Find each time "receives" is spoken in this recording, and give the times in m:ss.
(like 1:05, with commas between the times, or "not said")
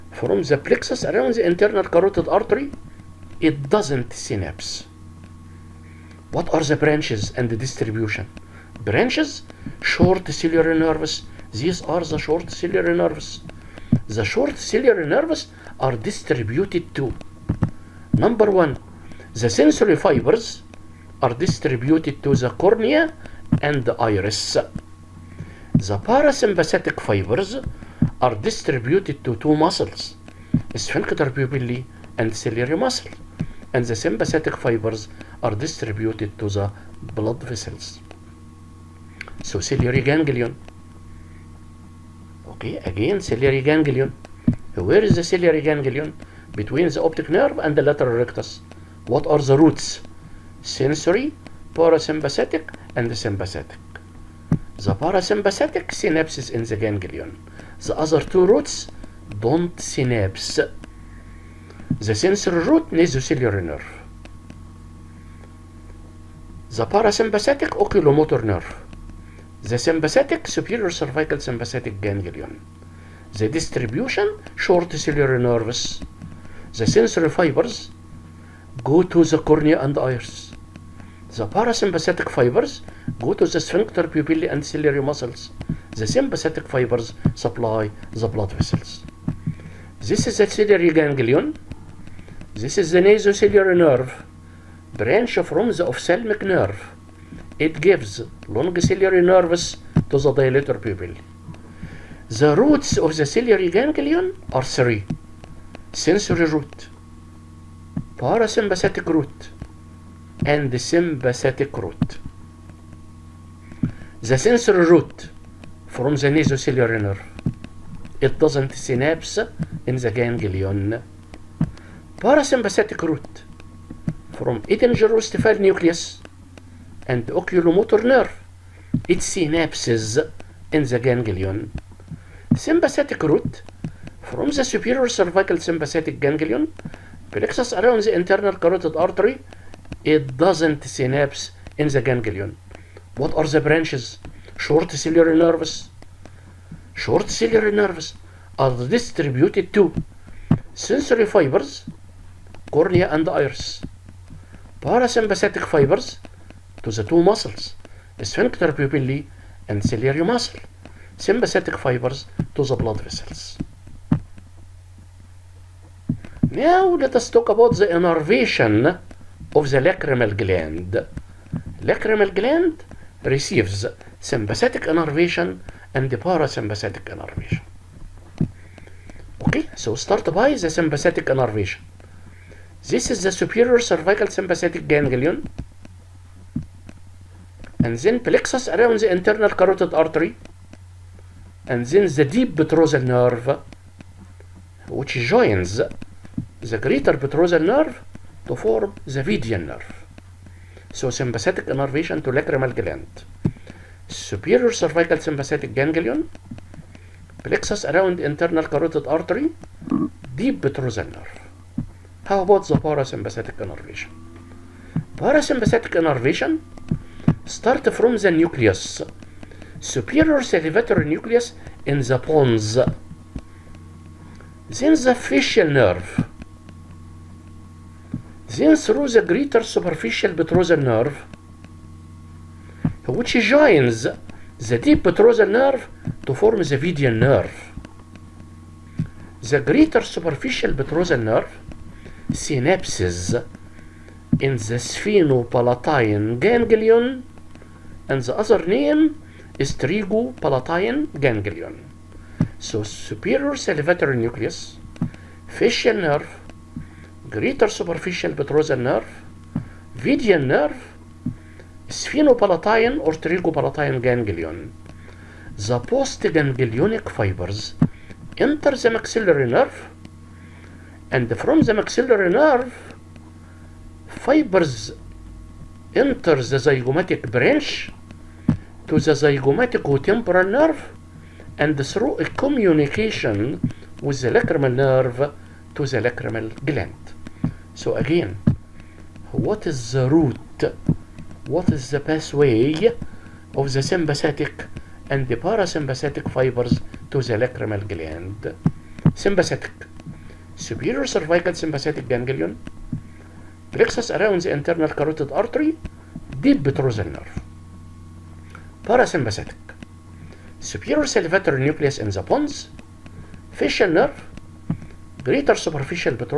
2:53.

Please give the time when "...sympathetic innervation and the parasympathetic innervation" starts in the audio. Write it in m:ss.
2:54.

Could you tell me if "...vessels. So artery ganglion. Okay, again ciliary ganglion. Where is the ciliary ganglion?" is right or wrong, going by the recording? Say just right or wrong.
wrong.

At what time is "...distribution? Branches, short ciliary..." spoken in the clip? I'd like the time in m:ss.
0:07.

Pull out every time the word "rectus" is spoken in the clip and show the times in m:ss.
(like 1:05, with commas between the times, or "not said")
0:48.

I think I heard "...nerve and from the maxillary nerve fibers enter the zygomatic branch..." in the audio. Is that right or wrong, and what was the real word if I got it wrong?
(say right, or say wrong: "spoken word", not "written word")
right.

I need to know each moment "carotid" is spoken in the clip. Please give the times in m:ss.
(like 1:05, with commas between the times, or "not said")
0:01, 2:18, 3:09, 3:28, 5:04.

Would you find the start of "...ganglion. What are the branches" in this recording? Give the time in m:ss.
2:22.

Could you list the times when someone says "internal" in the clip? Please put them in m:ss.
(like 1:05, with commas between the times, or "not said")
0:01, 2:18, 3:09, 3:28, 5:04.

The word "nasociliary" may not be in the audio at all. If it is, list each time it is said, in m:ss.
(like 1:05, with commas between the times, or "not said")
1:02, 1:33, 1:56.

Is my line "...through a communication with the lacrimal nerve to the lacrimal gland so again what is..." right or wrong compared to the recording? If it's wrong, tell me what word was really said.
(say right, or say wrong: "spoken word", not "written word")
right.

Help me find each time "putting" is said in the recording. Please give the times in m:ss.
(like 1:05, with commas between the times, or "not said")
not said.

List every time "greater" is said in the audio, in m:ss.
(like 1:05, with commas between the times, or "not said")
3:16, 3:49, 3:59, 4:17, 5:15.